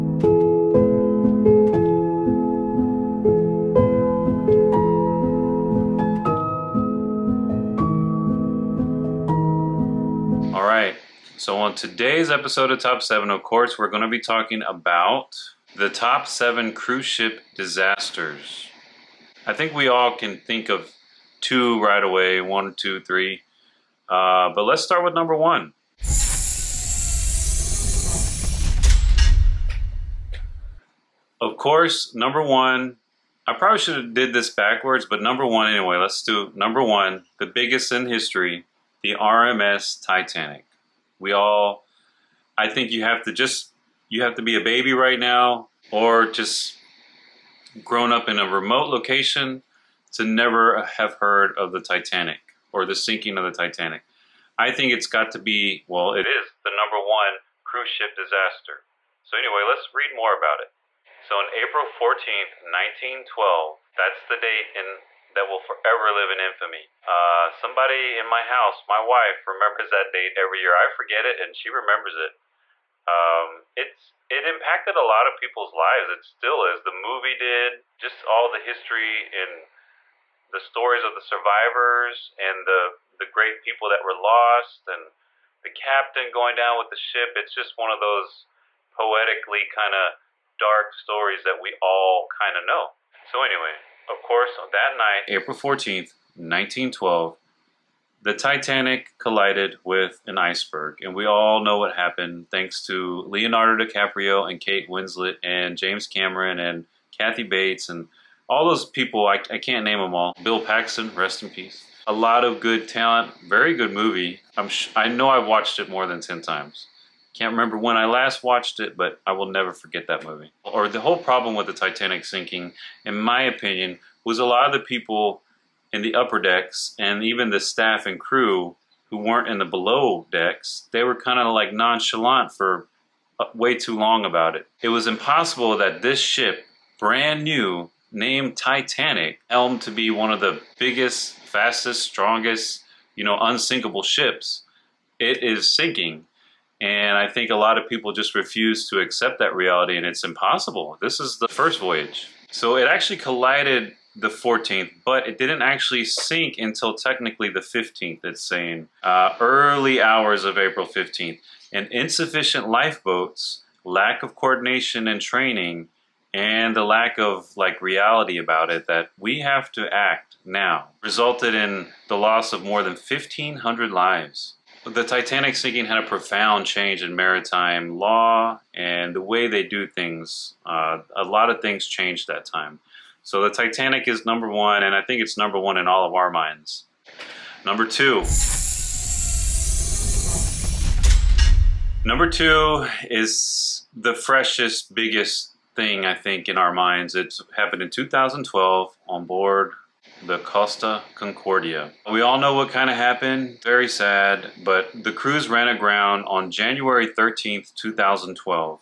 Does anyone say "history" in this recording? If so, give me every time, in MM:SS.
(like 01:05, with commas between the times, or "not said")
00:38, 01:18.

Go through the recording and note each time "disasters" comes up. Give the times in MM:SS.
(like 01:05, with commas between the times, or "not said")
00:17, 00:58.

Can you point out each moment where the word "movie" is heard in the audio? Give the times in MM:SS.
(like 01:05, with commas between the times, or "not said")
01:16, 01:53, 02:00.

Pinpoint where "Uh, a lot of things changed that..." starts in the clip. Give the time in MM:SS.
03:00.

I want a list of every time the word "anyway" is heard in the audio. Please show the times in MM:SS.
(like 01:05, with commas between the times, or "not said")
00:35, 00:59, 01:33.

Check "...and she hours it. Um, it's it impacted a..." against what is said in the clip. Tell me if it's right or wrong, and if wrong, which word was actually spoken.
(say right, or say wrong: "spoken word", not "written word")
wrong: "remembers", not "hours".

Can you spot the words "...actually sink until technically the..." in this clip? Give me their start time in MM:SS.
02:35.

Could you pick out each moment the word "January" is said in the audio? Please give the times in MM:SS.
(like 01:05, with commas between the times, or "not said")
03:26.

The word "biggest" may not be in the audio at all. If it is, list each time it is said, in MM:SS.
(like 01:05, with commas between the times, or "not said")
00:37, 02:20, 03:14.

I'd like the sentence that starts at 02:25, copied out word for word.
It is sinking and I think a lot of people just refuse to accept that reality, and it's impossible.